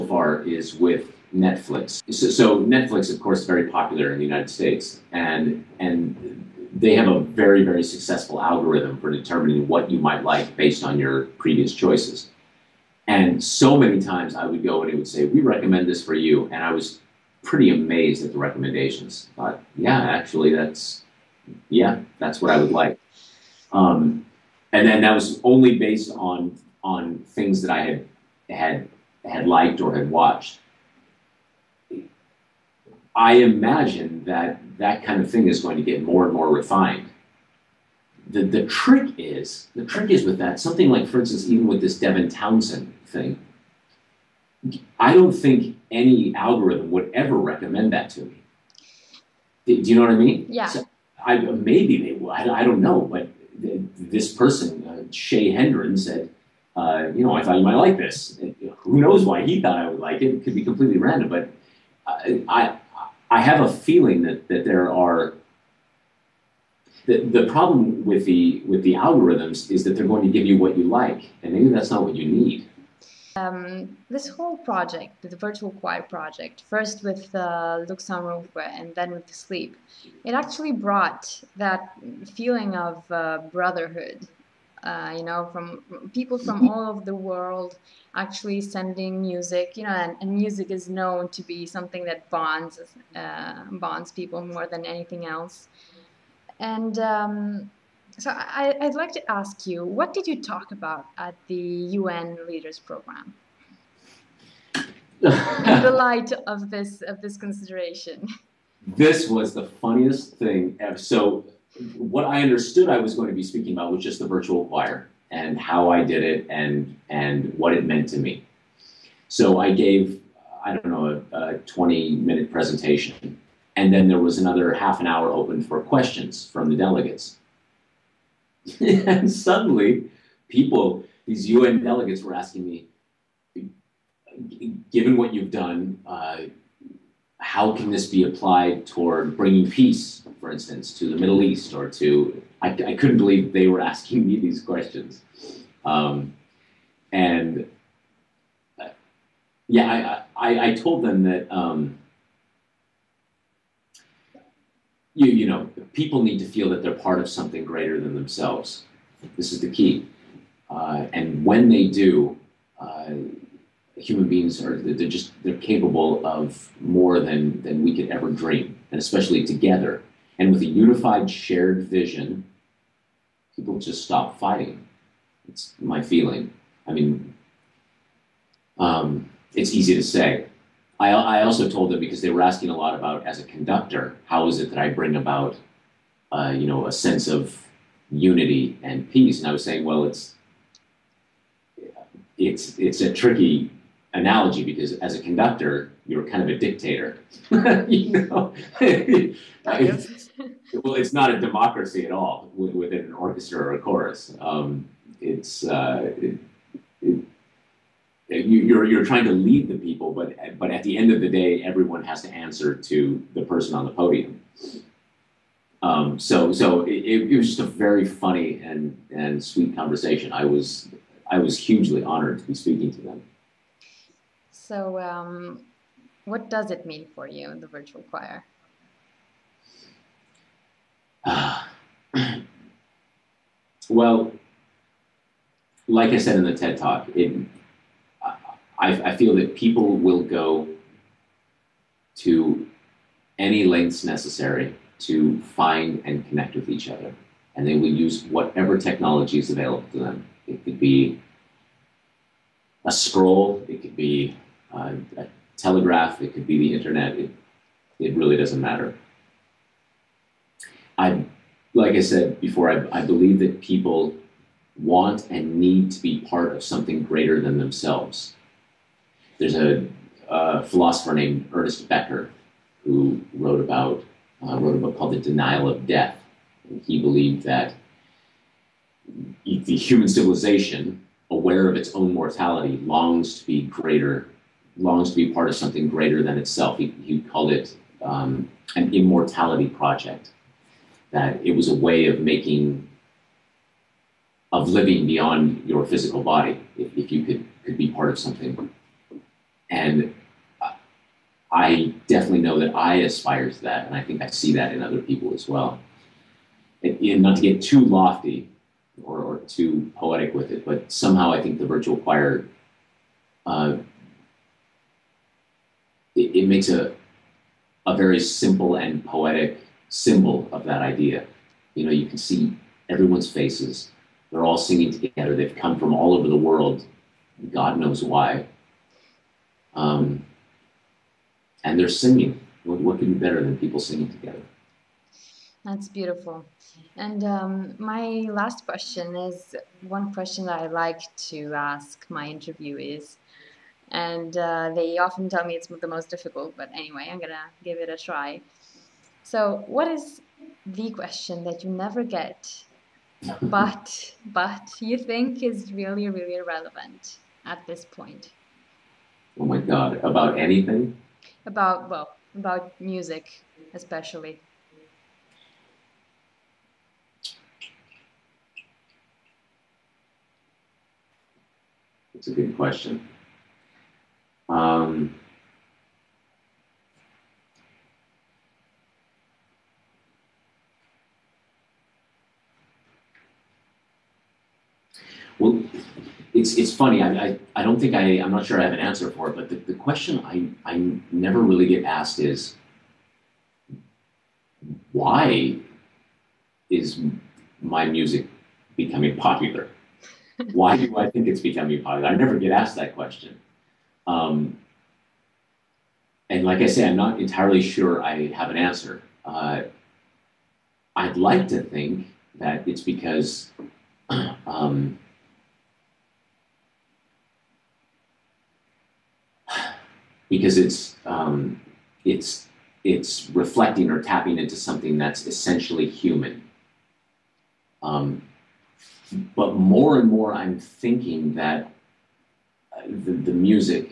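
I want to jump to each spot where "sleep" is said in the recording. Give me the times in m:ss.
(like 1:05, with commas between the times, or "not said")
1:19.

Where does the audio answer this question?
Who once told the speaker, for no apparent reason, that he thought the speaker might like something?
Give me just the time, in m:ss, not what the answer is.
0:55.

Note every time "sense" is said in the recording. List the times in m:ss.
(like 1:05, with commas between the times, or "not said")
3:06.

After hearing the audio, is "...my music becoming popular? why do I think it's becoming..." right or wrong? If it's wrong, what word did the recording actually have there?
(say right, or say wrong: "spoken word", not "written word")
right.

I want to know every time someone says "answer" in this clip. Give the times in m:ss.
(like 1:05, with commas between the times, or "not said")
3:32, 6:28, 6:48.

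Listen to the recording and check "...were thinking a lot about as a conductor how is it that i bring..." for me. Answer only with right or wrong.
wrong.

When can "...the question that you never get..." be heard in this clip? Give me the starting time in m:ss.
5:50.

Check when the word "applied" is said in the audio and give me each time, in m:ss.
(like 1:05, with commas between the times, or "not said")
2:18.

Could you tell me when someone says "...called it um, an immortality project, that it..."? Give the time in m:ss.
4:47.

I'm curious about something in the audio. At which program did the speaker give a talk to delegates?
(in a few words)
UN Leaders Program.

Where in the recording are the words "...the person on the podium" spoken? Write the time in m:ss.
3:33.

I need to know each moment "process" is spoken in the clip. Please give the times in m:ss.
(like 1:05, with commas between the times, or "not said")
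not said.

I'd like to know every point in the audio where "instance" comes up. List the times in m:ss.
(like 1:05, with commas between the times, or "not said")
0:41, 2:20.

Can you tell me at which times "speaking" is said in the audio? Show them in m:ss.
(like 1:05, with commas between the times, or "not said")
1:53, 3:42.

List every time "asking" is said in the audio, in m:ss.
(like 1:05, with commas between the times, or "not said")
2:12, 2:23, 3:02.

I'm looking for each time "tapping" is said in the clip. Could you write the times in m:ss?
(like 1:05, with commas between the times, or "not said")
7:04.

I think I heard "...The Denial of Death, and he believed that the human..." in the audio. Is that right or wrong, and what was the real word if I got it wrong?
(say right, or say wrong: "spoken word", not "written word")
right.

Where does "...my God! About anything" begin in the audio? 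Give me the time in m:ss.
5:59.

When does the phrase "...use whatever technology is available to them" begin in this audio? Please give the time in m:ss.
4:07.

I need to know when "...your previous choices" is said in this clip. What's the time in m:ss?
0:10.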